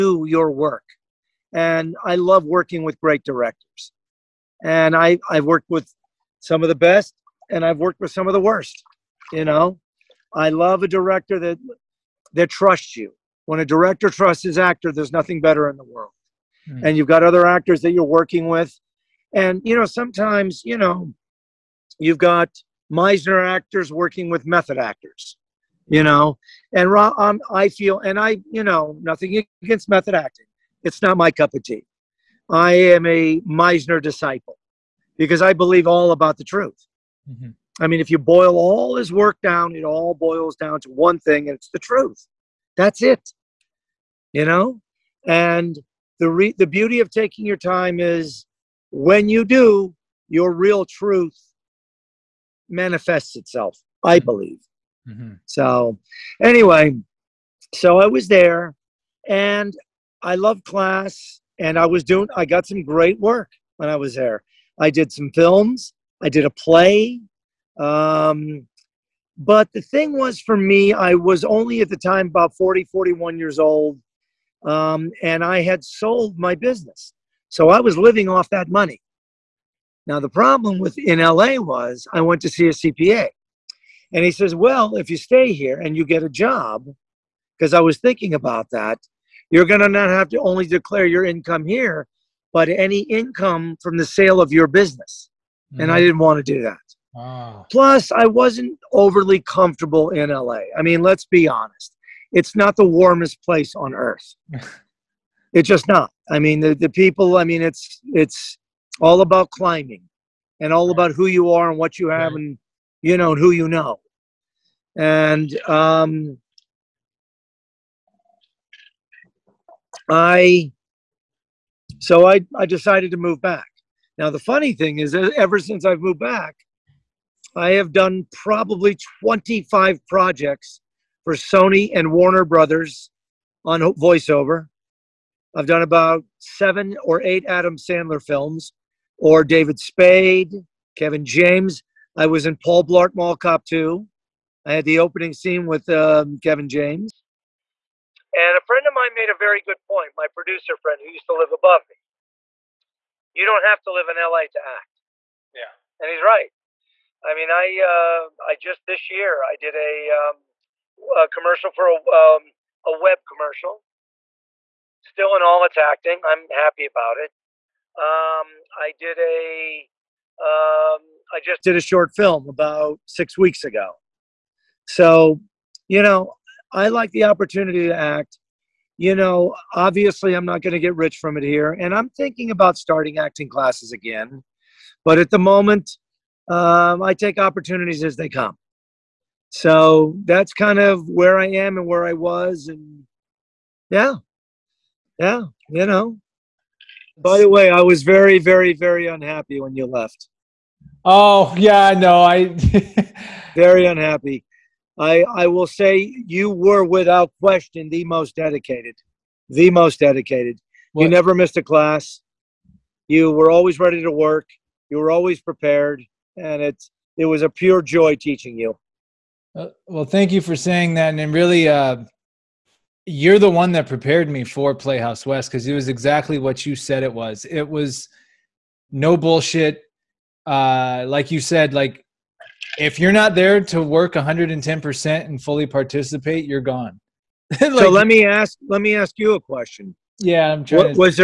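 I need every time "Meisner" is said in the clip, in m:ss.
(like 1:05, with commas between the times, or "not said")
0:22, 0:33.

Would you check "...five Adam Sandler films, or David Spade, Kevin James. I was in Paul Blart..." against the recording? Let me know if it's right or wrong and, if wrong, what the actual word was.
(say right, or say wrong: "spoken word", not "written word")
wrong: "eight", not "five".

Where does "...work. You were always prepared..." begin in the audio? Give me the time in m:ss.
3:34.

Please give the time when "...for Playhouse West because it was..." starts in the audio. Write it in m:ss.
3:44.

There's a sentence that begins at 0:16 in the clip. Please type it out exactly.
and you've got other actors that you're working with.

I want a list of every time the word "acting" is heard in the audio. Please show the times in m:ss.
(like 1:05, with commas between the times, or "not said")
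0:30, 2:45, 3:03.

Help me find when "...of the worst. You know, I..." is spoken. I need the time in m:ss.
0:08.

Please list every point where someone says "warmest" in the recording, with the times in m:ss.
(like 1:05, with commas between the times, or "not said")
1:42.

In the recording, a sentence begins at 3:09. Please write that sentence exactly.
So that's kind of where I am and where I was.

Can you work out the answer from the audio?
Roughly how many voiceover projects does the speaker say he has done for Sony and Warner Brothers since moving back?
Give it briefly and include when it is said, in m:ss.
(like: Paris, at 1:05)
25, at 2:09.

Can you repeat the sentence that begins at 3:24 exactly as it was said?
I I will say you were without question the most dedicated, the most dedicated.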